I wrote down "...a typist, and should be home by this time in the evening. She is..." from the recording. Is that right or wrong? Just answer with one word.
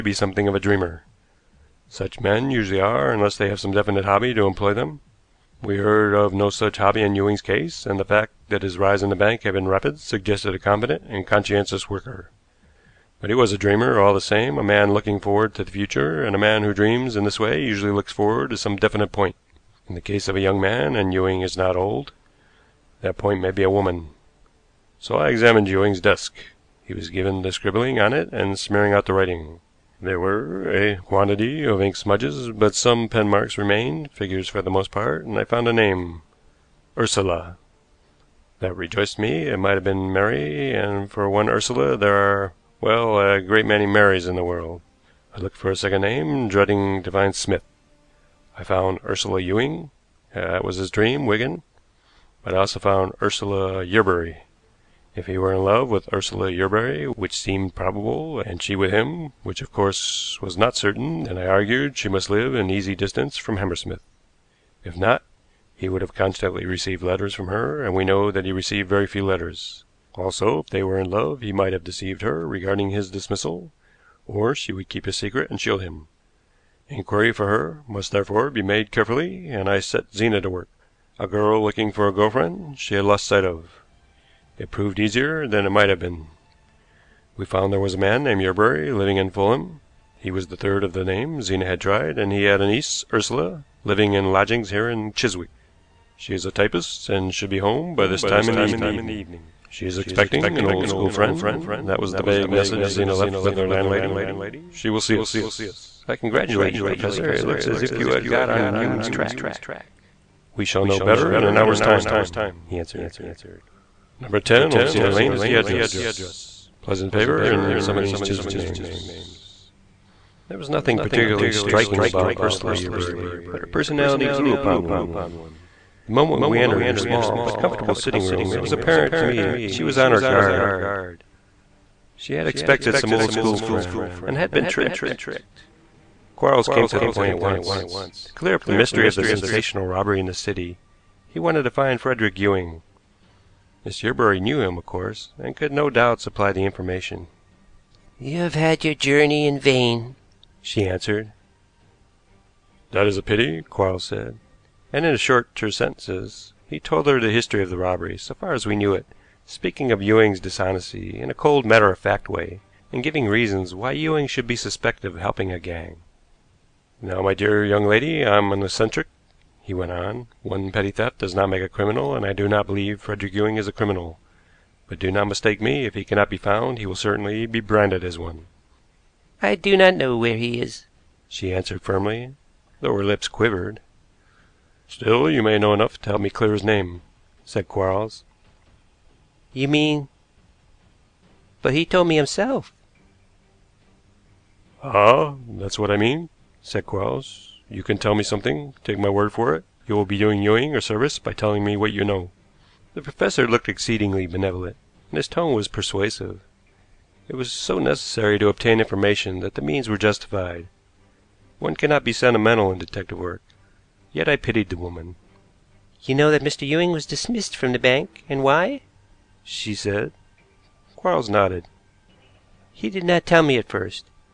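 right.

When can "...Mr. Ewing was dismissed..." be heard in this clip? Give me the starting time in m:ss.
3:36.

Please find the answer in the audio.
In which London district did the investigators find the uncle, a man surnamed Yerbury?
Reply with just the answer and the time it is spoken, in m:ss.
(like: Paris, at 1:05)
Fulham, at 1:29.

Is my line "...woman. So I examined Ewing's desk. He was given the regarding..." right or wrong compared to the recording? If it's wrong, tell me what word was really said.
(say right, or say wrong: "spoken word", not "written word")
wrong: "scribbling", not "regarding".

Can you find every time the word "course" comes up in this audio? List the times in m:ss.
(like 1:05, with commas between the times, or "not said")
0:59, 2:24.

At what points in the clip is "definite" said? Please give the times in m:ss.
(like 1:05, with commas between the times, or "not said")
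0:03, 0:18.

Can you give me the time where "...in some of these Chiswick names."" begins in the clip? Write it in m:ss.
1:57.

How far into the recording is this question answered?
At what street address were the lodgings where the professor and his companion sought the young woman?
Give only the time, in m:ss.
1:54.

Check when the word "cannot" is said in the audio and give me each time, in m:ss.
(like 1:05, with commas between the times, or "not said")
2:56, 3:31.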